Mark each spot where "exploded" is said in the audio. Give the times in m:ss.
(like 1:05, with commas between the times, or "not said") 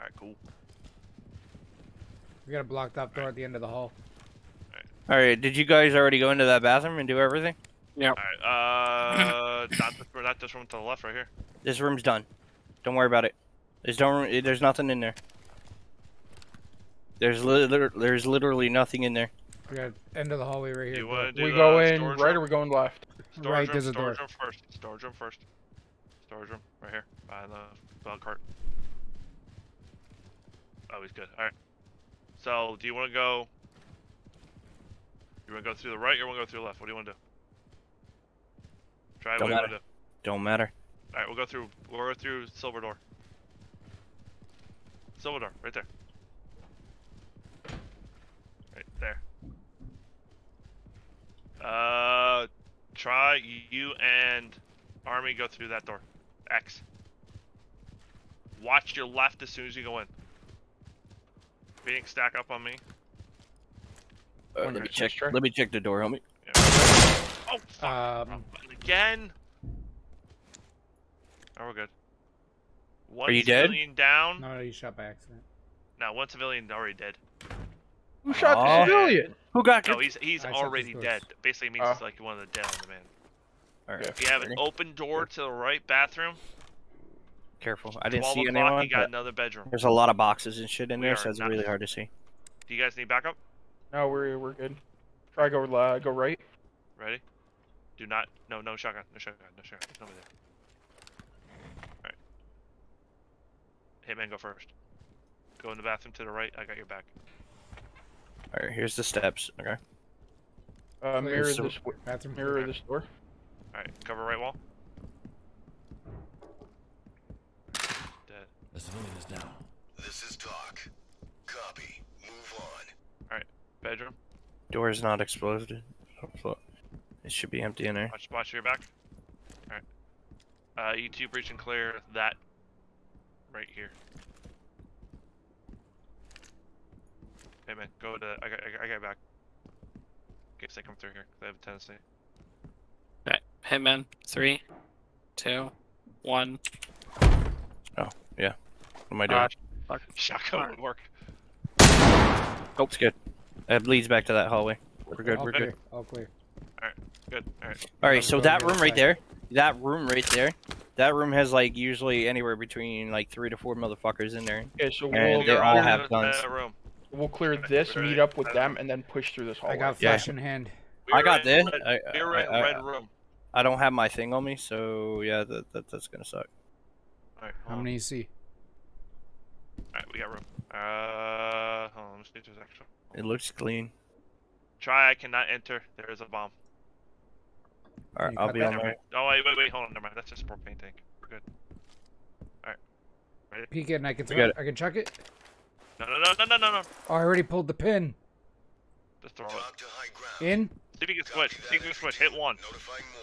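2:05.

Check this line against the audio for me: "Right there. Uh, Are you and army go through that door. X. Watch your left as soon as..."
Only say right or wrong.
wrong.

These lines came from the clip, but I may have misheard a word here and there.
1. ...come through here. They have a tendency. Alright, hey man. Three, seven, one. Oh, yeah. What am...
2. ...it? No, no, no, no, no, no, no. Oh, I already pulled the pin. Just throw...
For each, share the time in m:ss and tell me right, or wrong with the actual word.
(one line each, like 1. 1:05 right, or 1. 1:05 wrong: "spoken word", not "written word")
1. 2:20 wrong: "two", not "seven"
2. 3:14 right.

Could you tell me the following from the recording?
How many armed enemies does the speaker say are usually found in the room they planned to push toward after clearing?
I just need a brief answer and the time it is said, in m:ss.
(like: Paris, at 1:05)
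3 to 4, at 2:43.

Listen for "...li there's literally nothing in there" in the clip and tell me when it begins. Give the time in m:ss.
0:17.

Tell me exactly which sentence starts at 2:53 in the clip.
I don't have my thing on me, so yeah, that, that that's gonna suck.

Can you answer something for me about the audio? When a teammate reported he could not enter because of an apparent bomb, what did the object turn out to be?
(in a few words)
A propane tank.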